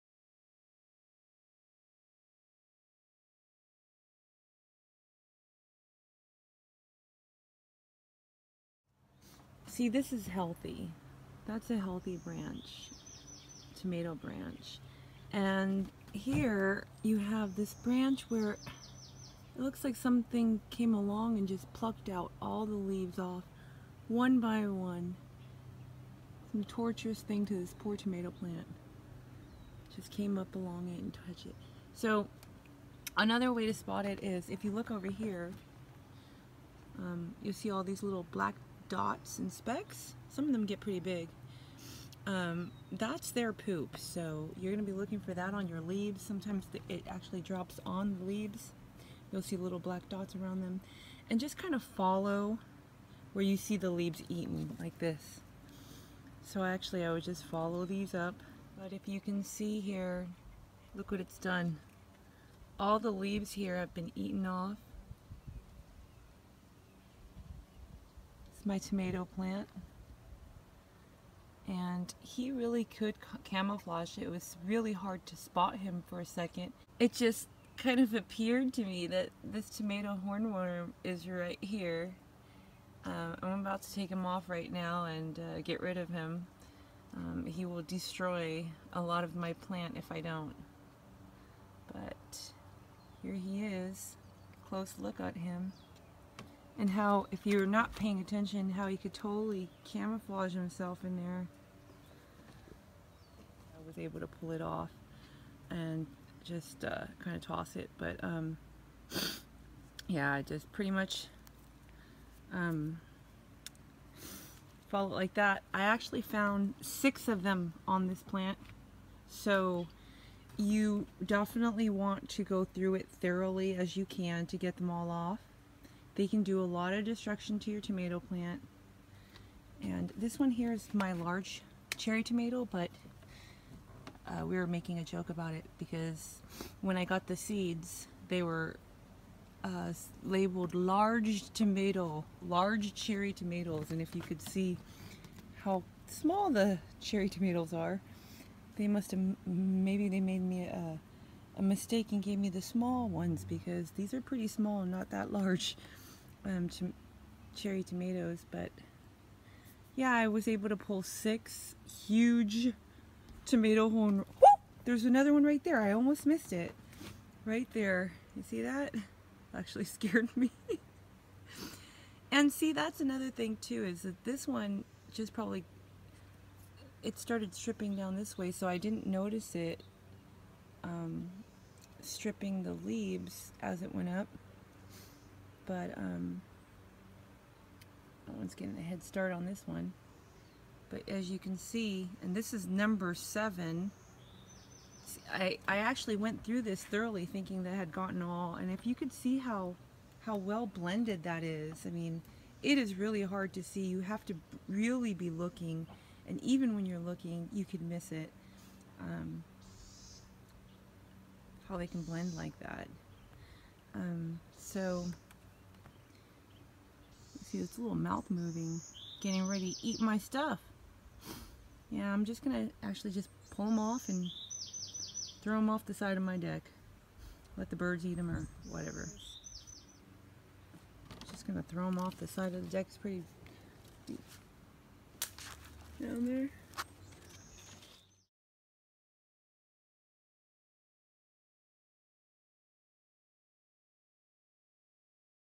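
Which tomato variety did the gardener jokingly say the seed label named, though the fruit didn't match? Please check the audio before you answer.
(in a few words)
Large cherry tomatoes.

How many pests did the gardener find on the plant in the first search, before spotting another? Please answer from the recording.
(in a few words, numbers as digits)
6.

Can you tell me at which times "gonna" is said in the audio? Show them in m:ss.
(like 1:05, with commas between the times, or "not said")
3:42, 3:51.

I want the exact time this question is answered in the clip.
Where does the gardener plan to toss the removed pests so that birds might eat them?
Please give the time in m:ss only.
3:45.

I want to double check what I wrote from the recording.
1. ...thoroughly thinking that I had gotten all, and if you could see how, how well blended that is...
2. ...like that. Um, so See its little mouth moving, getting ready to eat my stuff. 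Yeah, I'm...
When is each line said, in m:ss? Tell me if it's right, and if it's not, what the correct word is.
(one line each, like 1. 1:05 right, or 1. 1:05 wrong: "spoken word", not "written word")
1. 3:16 right
2. 3:32 right.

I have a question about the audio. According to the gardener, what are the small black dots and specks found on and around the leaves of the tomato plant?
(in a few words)
Poop.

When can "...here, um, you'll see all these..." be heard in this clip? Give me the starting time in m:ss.
0:35.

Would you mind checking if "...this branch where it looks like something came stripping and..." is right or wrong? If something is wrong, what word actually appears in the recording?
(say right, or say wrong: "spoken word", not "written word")
wrong: "along", not "stripping".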